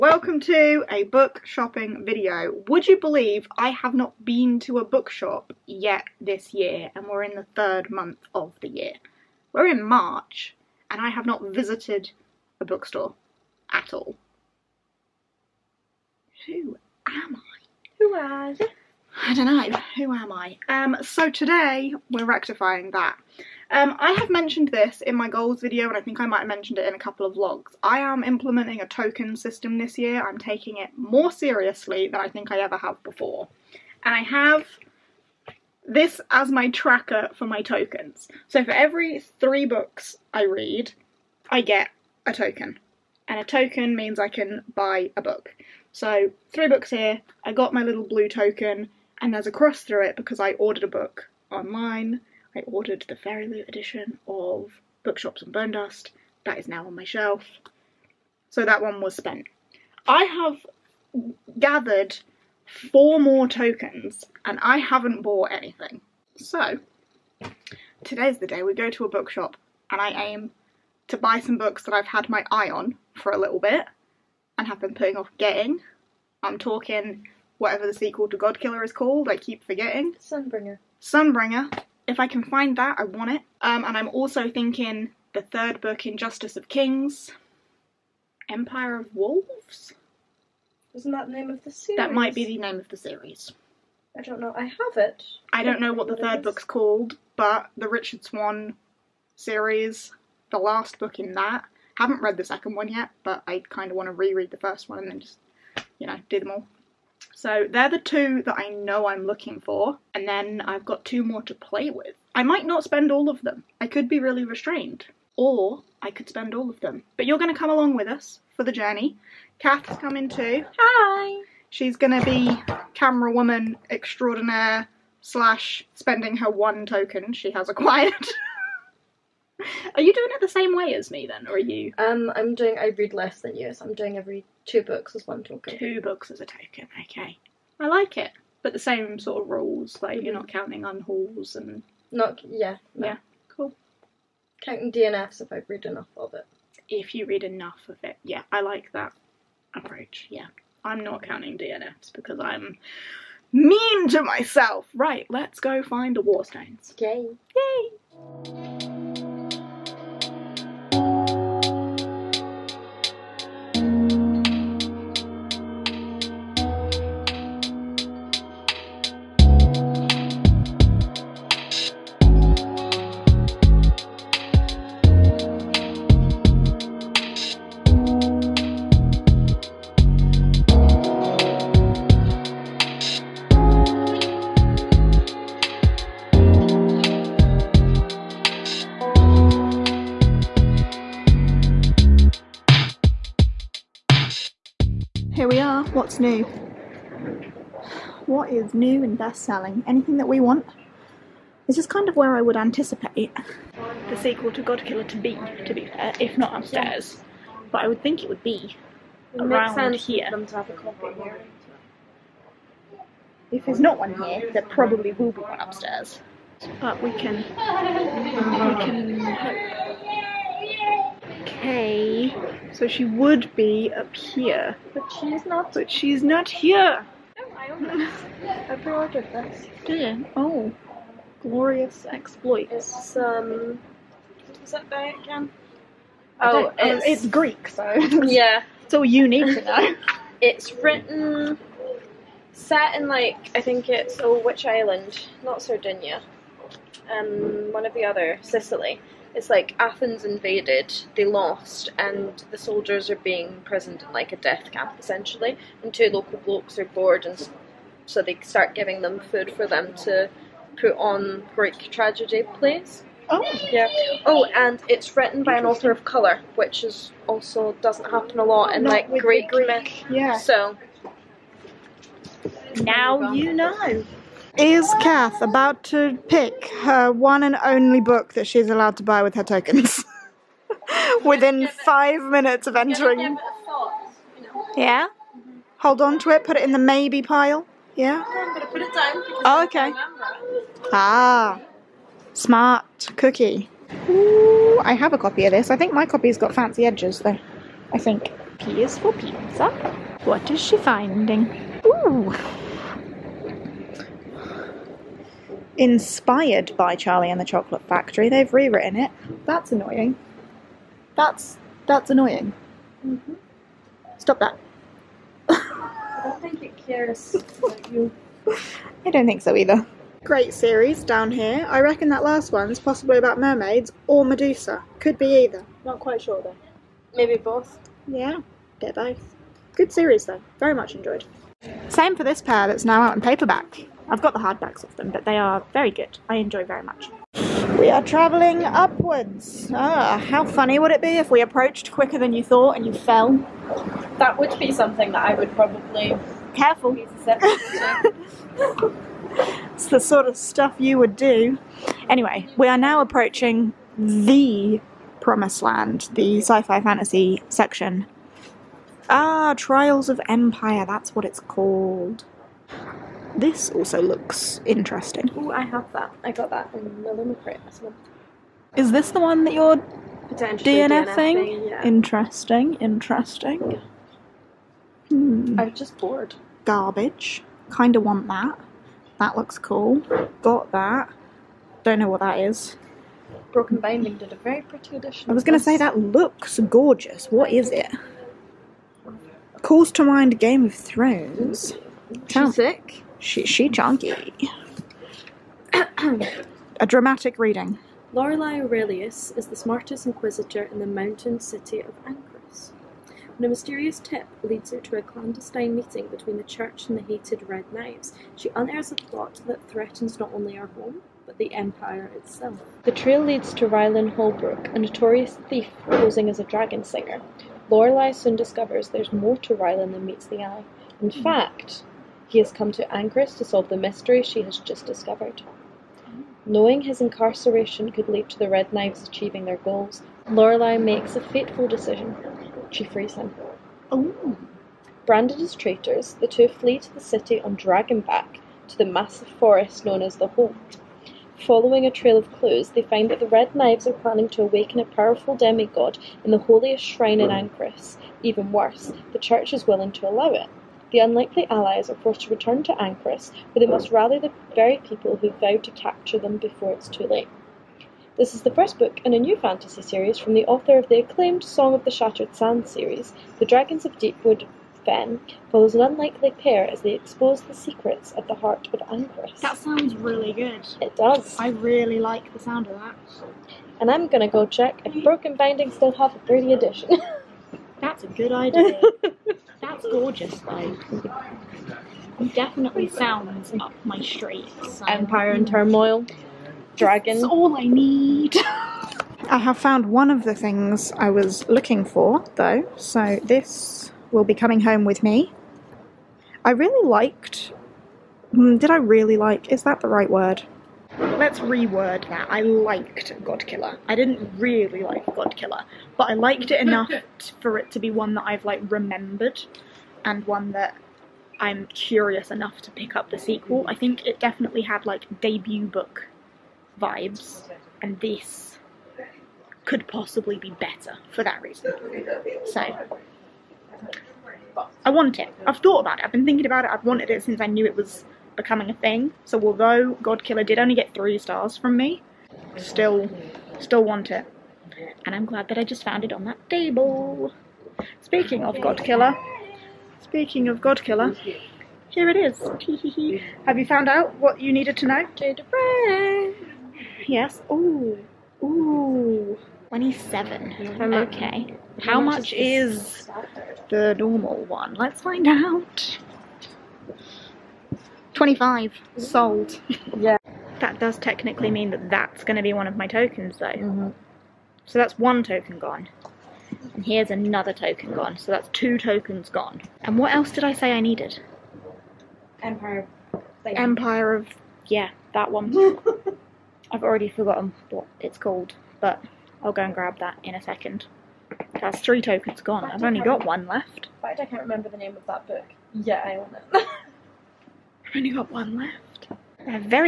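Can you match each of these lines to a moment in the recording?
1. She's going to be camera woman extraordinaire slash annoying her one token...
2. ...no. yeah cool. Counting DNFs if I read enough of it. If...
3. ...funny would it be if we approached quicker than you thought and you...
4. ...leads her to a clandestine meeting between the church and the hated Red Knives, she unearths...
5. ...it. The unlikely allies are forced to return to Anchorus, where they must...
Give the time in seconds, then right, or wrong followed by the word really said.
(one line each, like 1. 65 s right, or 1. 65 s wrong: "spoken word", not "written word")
1. 121 s wrong: "spending", not "annoying"
2. 142 s right
3. 340 s right
4. 404 s right
5. 450 s right.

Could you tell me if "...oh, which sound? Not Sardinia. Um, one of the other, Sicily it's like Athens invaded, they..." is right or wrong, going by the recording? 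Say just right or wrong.
wrong.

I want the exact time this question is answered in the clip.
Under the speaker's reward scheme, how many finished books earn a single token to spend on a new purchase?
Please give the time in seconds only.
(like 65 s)
38 s.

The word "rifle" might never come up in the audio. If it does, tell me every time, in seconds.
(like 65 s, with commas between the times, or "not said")
not said.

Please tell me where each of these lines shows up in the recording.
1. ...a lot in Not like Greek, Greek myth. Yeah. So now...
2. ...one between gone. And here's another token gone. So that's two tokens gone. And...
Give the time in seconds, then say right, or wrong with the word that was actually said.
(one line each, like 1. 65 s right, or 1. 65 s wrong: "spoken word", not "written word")
1. 268 s right
2. 564 s wrong: "token", not "between".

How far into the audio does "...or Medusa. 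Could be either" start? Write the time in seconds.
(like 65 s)
324 s.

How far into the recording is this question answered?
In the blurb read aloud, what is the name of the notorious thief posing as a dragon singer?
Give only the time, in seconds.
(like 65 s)
413 s.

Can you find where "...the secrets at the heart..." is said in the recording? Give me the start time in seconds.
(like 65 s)
467 s.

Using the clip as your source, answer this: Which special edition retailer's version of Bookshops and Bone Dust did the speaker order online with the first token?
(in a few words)
Fairy Loot.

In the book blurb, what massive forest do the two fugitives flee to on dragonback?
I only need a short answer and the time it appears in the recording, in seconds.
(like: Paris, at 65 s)
the Holt, at 440 s.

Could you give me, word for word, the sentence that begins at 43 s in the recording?
And a token means I can buy a book.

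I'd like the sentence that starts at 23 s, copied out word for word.
Um, I have mentioned this in my goals video and I think I might have mentioned it in a couple of vlogs.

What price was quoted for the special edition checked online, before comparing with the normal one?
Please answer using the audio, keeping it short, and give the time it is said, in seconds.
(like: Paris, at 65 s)
27, at 549 s.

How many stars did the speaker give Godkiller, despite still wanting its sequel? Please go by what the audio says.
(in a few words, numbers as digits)
3.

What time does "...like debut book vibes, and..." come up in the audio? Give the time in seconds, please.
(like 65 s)
514 s.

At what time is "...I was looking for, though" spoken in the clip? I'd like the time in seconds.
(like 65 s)
490 s.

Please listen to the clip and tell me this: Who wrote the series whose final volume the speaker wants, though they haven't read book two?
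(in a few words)
Richard Swan.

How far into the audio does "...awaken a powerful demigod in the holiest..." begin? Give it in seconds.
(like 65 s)
444 s.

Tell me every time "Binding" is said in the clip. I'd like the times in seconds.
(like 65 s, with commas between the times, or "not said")
383 s, 475 s.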